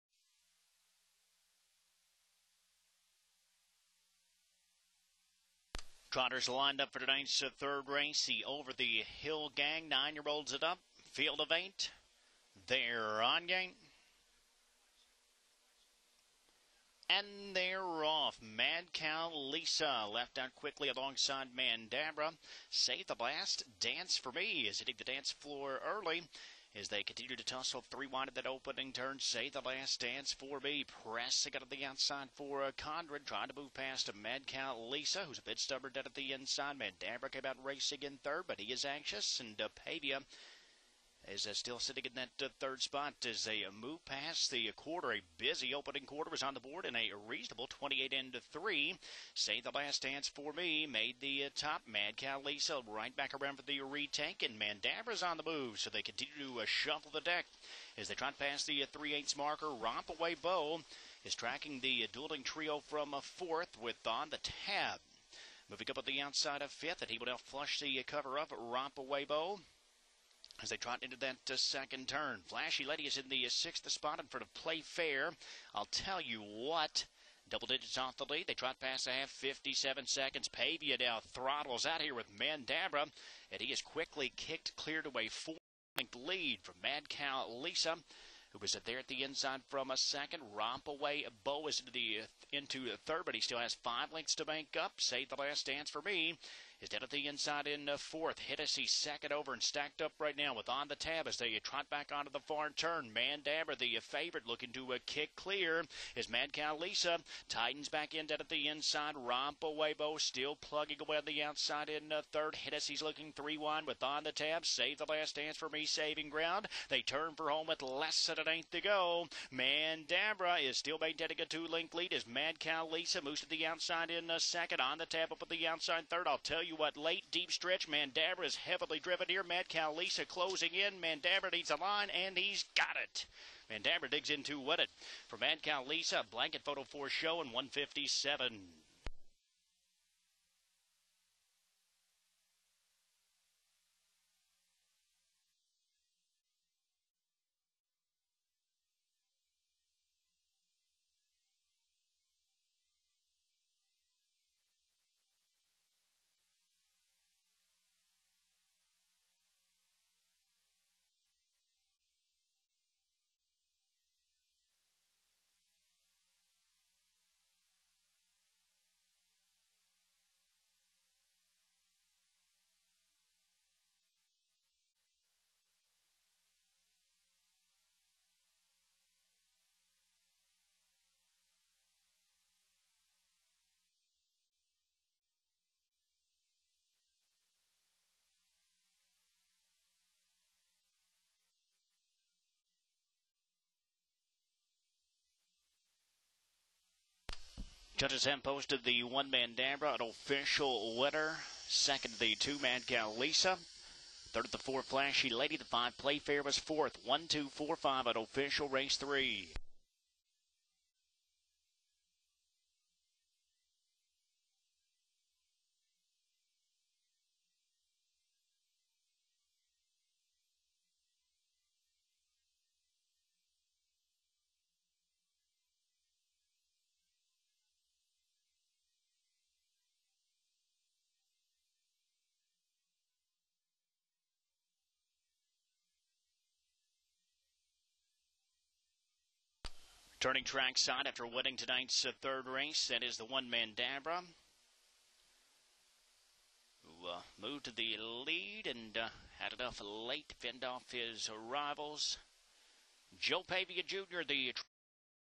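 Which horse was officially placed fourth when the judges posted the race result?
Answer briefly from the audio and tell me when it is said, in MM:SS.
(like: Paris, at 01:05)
Playfair, at 03:25.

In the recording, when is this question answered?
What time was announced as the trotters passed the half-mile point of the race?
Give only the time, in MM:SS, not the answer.
01:19.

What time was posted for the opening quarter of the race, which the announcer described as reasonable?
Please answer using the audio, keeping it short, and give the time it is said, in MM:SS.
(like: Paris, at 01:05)
28 and 3, at 00:47.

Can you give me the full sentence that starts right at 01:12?
Flashy Lady is in the uh, sixth spot in front of Play Fair.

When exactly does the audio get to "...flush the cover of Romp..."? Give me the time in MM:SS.
01:07.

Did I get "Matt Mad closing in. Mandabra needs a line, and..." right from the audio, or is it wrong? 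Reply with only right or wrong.
wrong.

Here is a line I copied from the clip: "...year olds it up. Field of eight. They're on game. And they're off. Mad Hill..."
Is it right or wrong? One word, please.
wrong.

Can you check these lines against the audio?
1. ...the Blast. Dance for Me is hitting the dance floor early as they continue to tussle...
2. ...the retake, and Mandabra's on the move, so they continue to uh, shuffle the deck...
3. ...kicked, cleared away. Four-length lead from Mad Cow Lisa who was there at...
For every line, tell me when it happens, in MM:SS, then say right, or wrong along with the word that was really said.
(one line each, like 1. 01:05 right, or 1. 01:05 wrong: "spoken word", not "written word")
1. 00:23 right
2. 00:53 right
3. 01:24 right.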